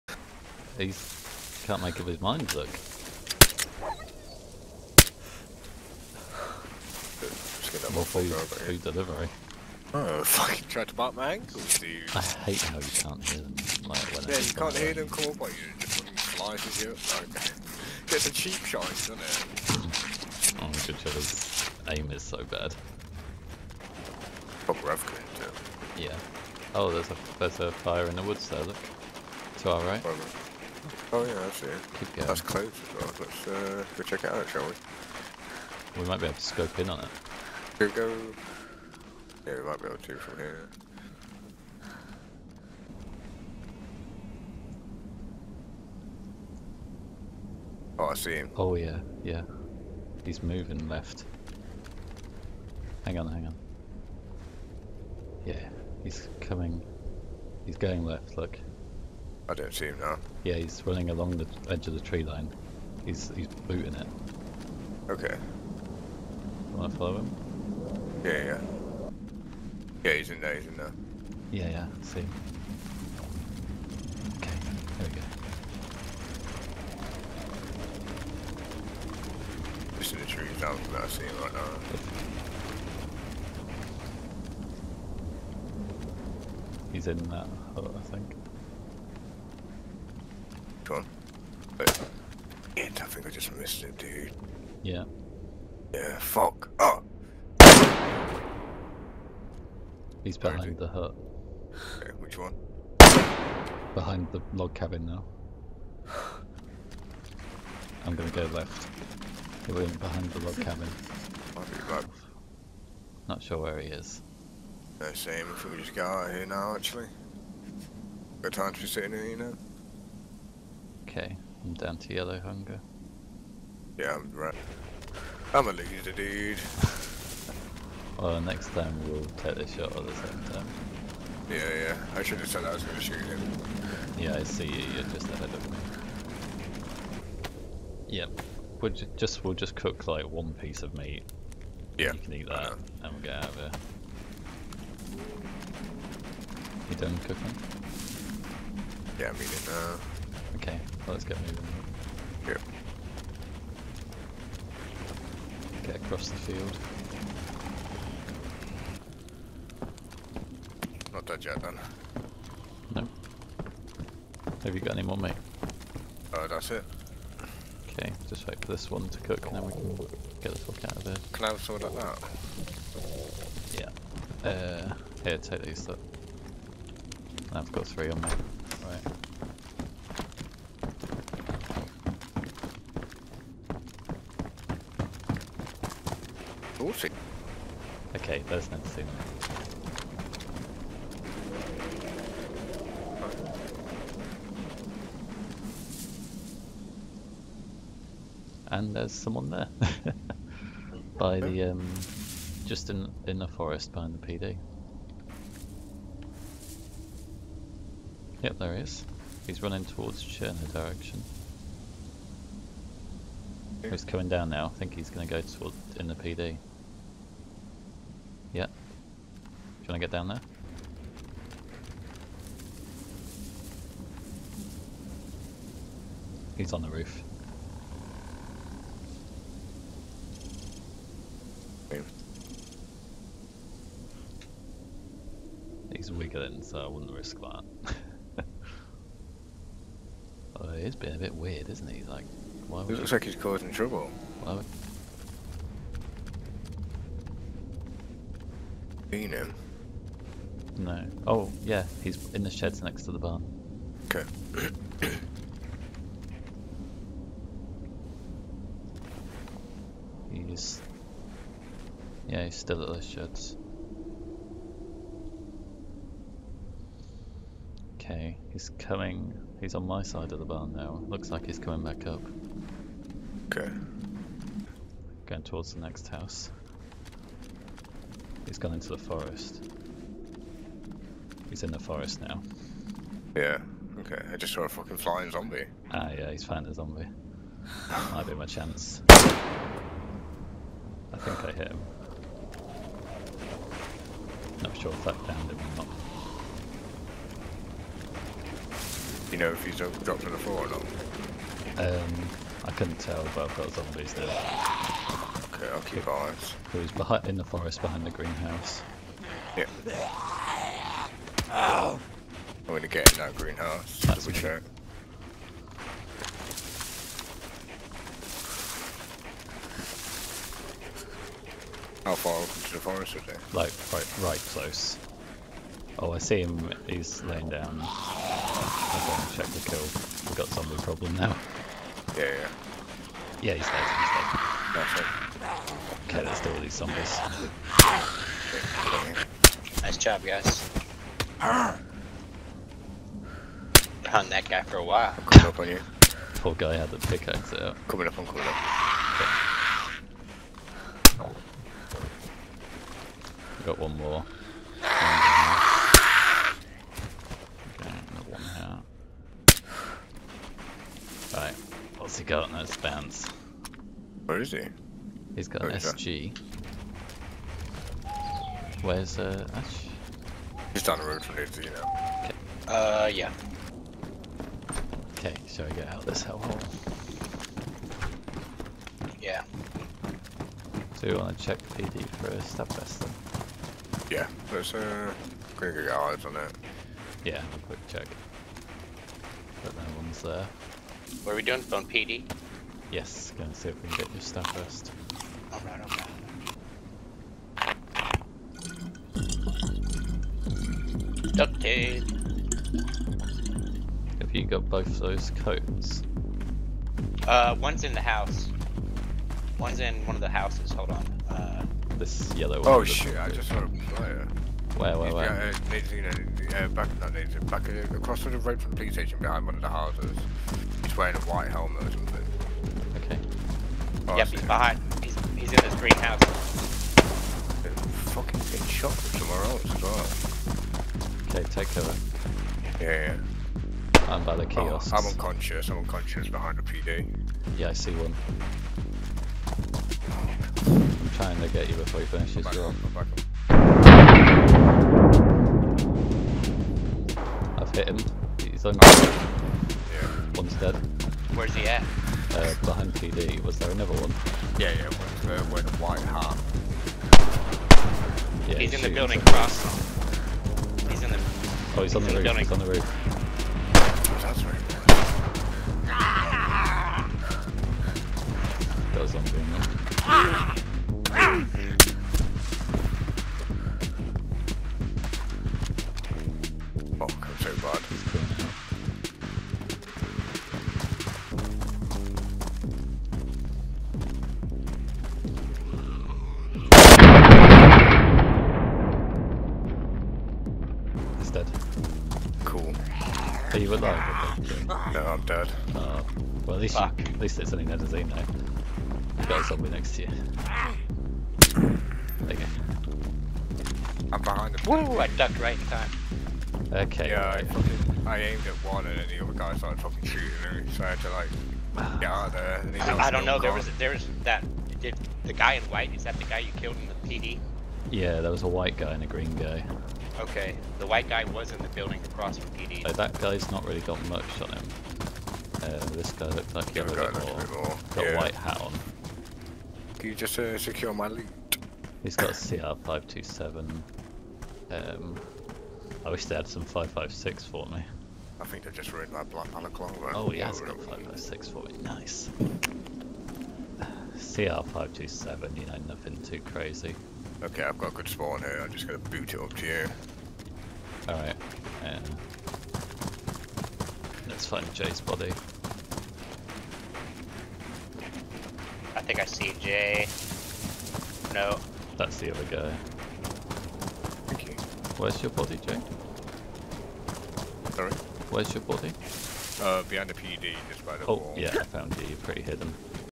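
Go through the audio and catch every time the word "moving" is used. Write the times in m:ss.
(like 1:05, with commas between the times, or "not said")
0:50, 2:31.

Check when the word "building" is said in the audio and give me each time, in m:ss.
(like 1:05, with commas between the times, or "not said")
7:38, 8:41.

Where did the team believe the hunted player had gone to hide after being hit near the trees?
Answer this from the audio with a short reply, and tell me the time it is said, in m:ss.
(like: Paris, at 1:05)
the forest behind the greenhouse, at 5:07.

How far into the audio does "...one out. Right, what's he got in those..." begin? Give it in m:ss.
5:58.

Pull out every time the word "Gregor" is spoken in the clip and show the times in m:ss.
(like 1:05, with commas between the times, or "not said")
6:25.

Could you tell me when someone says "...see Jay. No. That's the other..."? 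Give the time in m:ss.
9:19.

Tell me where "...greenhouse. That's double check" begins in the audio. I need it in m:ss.
5:13.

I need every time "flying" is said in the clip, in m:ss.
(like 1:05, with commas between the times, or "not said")
4:44.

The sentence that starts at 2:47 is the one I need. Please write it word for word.
Okay, just wait for this one to cook and then we can get the fuck out of here.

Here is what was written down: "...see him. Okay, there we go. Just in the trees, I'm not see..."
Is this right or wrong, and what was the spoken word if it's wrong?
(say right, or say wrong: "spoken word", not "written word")
right.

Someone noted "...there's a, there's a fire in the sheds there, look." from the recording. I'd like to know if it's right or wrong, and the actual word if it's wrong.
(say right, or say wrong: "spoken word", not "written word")
wrong: "woods", not "sheds".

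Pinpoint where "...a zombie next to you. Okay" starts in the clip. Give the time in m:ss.
8:19.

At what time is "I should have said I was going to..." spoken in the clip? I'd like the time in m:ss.
2:12.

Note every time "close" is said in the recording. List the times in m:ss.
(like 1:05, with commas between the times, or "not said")
0:32, 5:24.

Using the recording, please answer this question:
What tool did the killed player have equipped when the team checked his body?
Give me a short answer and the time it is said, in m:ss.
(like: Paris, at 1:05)
pickaxe, at 5:46.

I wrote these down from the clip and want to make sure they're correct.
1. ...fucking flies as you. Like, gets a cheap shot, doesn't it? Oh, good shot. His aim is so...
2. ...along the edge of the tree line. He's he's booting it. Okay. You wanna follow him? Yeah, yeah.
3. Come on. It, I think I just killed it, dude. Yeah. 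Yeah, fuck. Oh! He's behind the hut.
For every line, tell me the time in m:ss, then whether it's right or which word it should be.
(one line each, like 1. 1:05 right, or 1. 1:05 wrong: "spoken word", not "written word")
1. 0:15 right
2. 1:01 right
3. 1:30 wrong: "missed", not "killed".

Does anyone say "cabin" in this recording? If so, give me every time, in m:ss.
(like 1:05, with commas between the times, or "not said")
1:44, 1:50.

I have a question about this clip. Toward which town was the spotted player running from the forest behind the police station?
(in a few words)
Cherna.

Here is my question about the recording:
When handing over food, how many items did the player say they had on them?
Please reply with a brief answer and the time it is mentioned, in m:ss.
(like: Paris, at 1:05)
3, at 2:57.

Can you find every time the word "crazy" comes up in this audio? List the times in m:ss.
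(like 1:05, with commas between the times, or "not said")
9:06.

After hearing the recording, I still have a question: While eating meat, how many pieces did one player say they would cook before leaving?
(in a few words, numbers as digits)
1.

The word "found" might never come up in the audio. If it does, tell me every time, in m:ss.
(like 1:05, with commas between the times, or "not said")
4:46, 9:31.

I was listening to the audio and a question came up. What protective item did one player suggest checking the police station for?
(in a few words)
stab vest.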